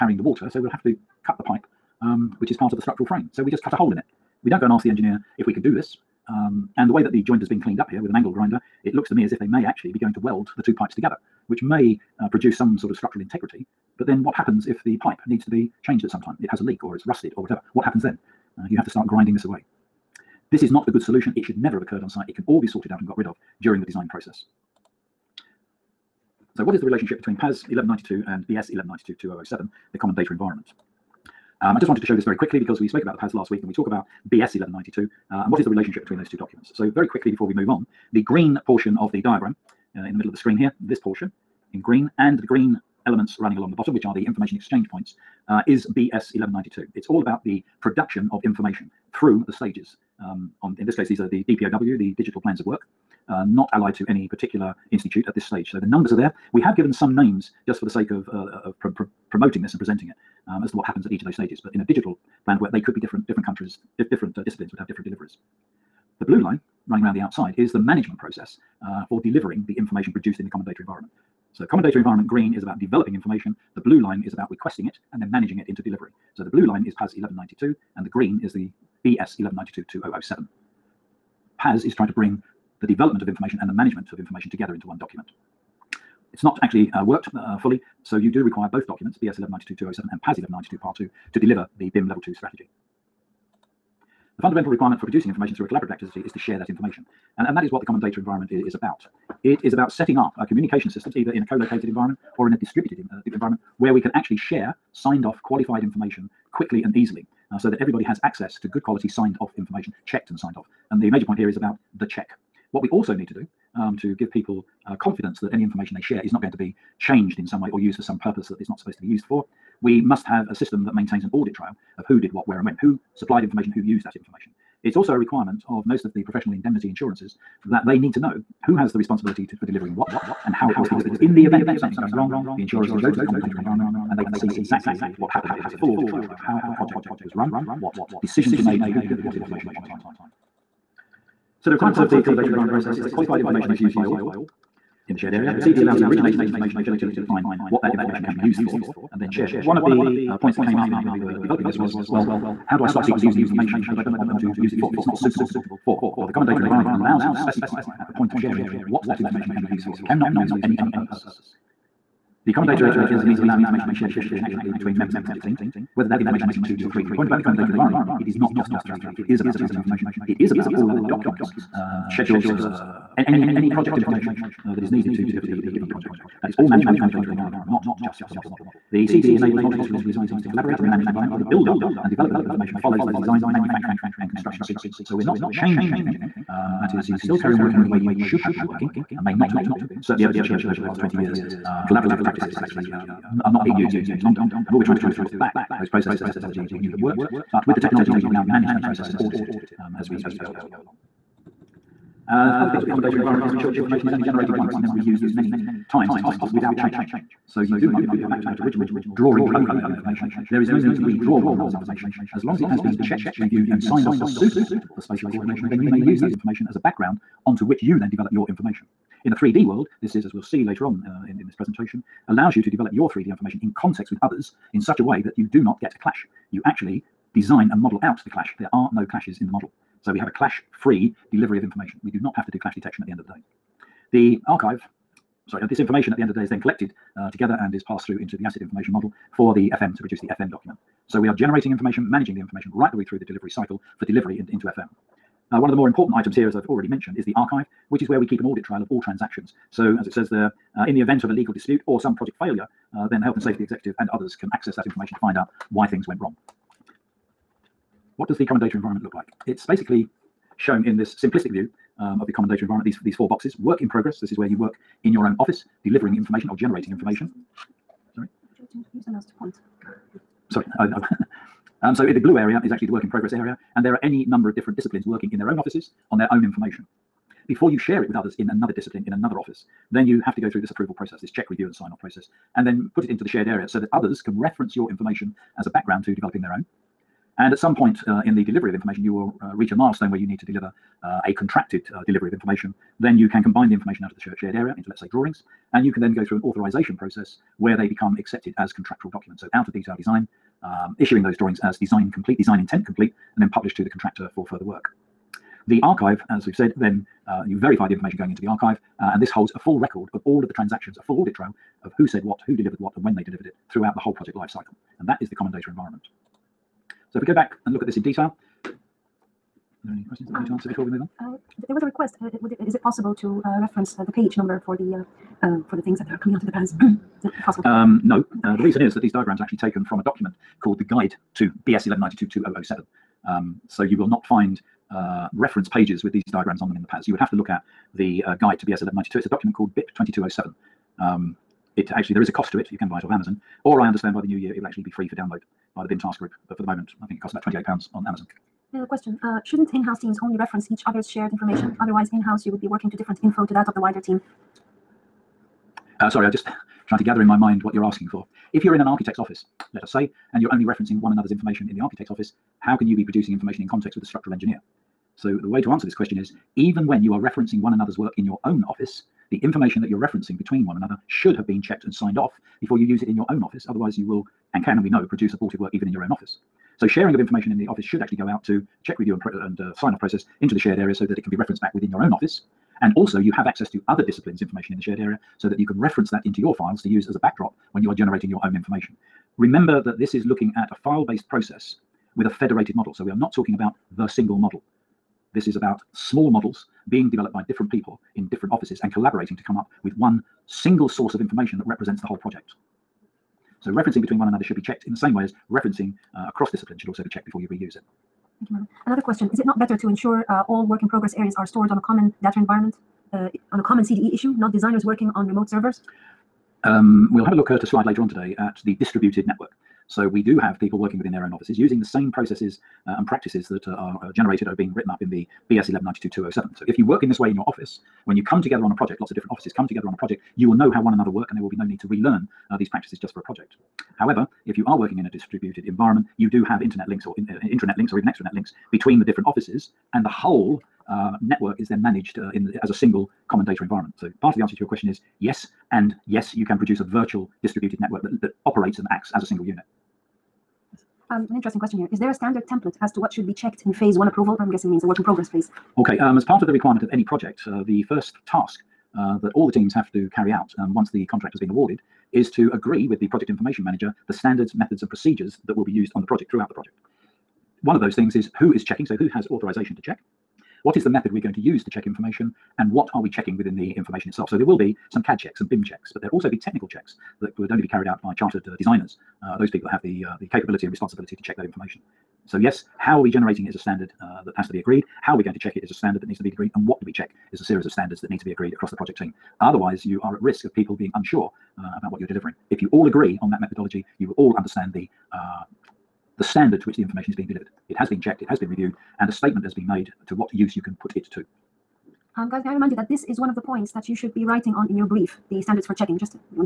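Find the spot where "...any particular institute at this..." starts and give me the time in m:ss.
0:54.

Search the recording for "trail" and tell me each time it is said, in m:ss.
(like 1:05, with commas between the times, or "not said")
2:01, 2:16, 4:08, 5:11.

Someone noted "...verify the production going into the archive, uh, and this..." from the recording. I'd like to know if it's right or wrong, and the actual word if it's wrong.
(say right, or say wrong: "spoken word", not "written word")
wrong: "information", not "production".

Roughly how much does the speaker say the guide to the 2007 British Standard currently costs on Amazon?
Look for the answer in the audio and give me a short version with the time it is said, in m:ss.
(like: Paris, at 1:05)
£28, at 5:47.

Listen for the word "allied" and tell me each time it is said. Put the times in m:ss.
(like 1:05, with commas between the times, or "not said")
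0:53.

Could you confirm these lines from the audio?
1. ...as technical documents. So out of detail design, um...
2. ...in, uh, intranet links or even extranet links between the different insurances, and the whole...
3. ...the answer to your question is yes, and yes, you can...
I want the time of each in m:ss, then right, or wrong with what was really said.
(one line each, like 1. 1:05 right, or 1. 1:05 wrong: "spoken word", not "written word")
1. 4:58 wrong: "contractual", not "technical"
2. 7:17 wrong: "offices", not "insurances"
3. 7:24 right.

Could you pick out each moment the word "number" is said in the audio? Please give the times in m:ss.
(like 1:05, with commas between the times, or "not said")
0:55, 4:34, 5:24.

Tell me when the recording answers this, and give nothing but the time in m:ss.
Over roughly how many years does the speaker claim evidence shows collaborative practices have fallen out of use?
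3:10.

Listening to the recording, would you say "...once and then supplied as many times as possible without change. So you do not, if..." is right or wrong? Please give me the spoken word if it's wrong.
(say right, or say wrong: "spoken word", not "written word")
wrong: "reused", not "supplied".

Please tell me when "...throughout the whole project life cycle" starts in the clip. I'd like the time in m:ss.
5:13.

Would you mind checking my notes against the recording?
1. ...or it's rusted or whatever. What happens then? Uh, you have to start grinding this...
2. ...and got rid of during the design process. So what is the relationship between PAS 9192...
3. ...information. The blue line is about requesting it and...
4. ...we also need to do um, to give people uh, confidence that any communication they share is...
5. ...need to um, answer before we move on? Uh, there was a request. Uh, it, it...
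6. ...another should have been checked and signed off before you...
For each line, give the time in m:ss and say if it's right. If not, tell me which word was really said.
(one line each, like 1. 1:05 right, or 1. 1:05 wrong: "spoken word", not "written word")
1. 0:16 right
2. 0:23 wrong: "1192", not "9192"
3. 1:13 right
4. 1:52 wrong: "information", not "communication"
5. 5:20 right
6. 6:10 right.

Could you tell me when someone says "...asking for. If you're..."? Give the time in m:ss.
5:57.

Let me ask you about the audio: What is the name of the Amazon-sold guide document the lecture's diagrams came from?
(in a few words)
BIP 2207.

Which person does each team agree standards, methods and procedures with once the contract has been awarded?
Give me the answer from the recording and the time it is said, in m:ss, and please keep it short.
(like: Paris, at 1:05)
project information manager, at 7:43.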